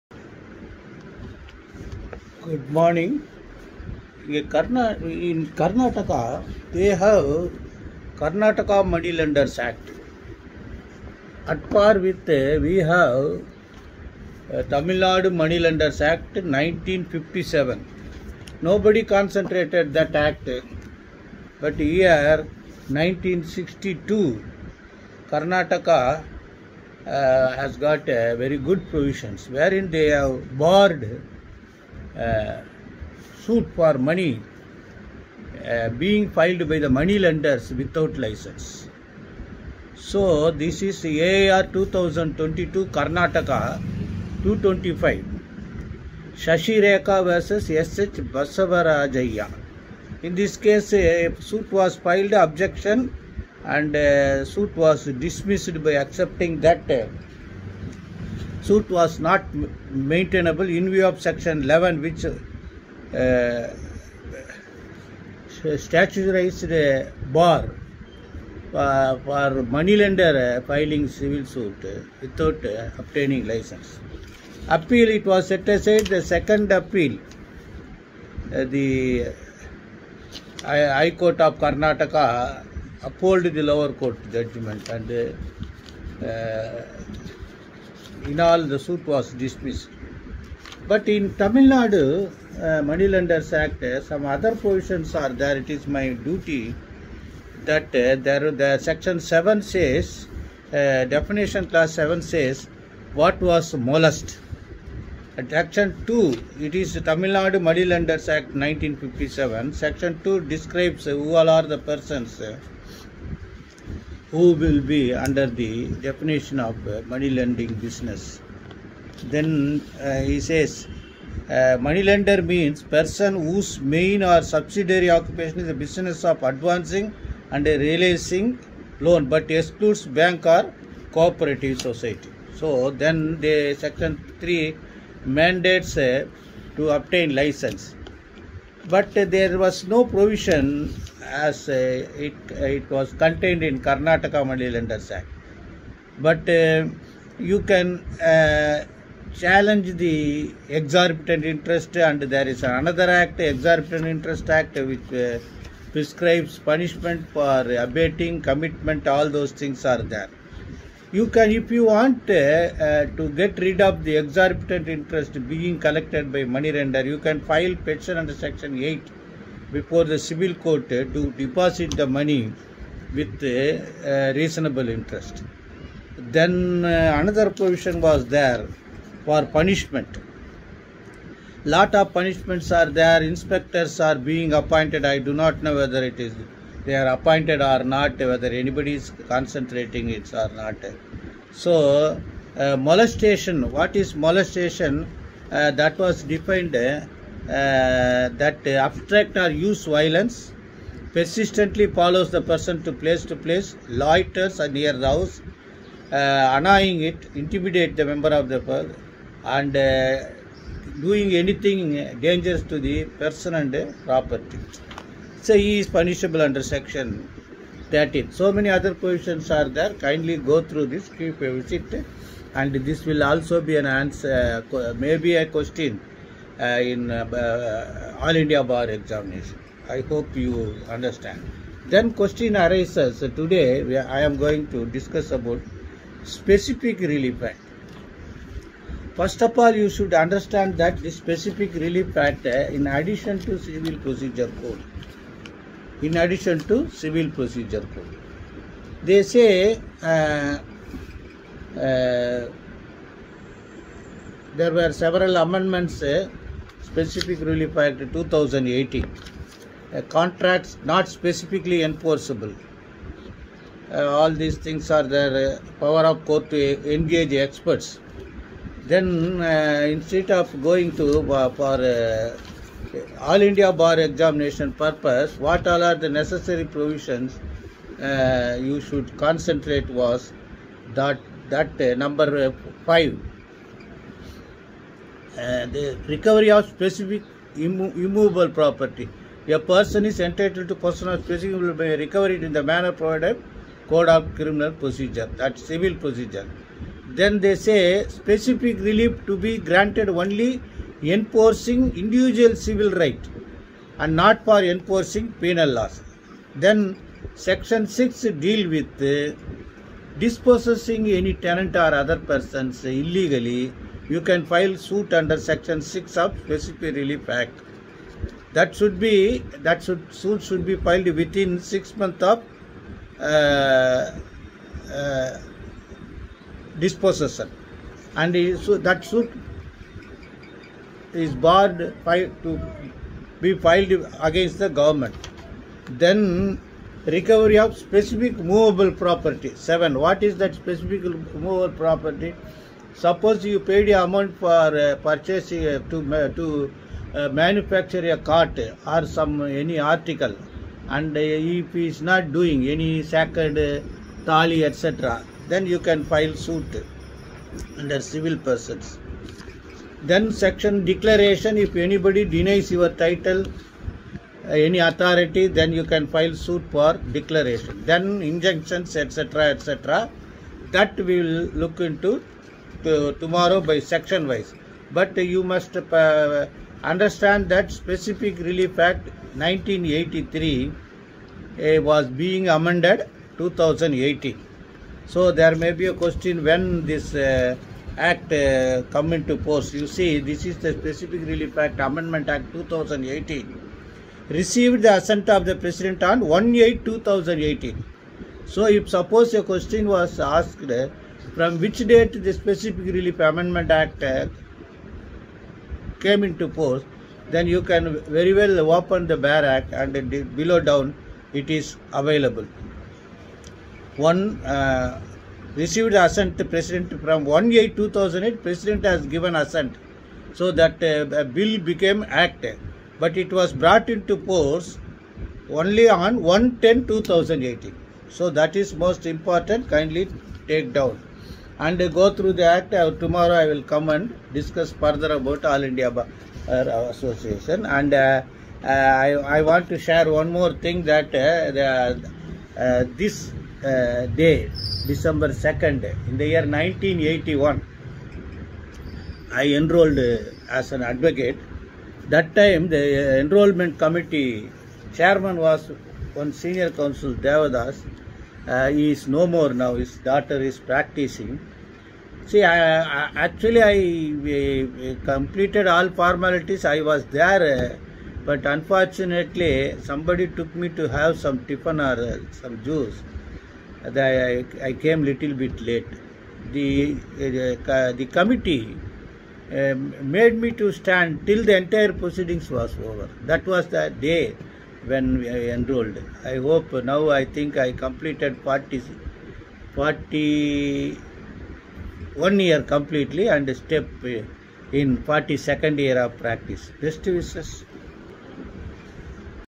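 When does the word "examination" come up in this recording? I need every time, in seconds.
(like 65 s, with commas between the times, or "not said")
228 s, 274 s.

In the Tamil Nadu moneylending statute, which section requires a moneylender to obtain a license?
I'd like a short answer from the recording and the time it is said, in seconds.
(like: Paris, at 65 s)
Section 3, at 133 s.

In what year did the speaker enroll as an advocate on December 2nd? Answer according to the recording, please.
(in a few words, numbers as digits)
1981.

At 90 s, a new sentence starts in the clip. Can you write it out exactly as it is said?
But in Tamil Nadu uh, Money Lenders Act, uh, some other provisions are there.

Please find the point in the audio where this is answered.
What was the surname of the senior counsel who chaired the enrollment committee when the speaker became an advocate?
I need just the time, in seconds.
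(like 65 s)
457 s.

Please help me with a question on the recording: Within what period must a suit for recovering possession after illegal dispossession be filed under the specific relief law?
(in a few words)
6 months.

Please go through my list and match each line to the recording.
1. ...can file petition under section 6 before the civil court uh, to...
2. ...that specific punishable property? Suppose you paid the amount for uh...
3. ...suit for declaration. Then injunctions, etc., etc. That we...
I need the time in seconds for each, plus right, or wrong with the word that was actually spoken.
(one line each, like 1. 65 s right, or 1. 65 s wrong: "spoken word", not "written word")
1. 167 s wrong: "8", not "6"
2. 340 s wrong: "movable", not "punishable"
3. 366 s right.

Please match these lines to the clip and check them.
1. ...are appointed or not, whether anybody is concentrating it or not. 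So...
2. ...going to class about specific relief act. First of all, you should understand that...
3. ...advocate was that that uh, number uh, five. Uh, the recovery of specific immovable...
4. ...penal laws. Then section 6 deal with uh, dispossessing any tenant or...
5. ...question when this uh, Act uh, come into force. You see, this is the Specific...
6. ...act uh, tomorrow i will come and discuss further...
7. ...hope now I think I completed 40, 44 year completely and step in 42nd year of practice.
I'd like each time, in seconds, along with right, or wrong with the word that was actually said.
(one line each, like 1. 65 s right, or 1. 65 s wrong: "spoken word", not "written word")
1. 186 s right
2. 234 s wrong: "discuss", not "class"
3. 279 s wrong: "concentrate", not "advocate"
4. 305 s right
5. 385 s right
6. 432 s right
7. 486 s wrong: "41", not "44".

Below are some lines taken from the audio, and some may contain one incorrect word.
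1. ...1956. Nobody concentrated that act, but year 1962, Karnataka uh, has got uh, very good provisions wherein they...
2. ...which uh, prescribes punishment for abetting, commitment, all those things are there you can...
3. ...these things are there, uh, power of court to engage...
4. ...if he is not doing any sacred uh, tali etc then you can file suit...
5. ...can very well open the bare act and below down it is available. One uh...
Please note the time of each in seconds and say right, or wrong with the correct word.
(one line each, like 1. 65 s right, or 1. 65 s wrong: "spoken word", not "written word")
1. 16 s wrong: "1957", not "1956"
2. 154 s right
3. 264 s right
4. 351 s right
5. 407 s right.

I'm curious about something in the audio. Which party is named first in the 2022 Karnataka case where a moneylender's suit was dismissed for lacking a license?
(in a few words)
Shashi Rekha.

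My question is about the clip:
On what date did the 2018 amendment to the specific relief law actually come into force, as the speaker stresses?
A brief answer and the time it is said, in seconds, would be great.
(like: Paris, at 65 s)
1-10-2018, at 426 s.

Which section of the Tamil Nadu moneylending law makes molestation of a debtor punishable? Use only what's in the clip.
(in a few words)
Section 13.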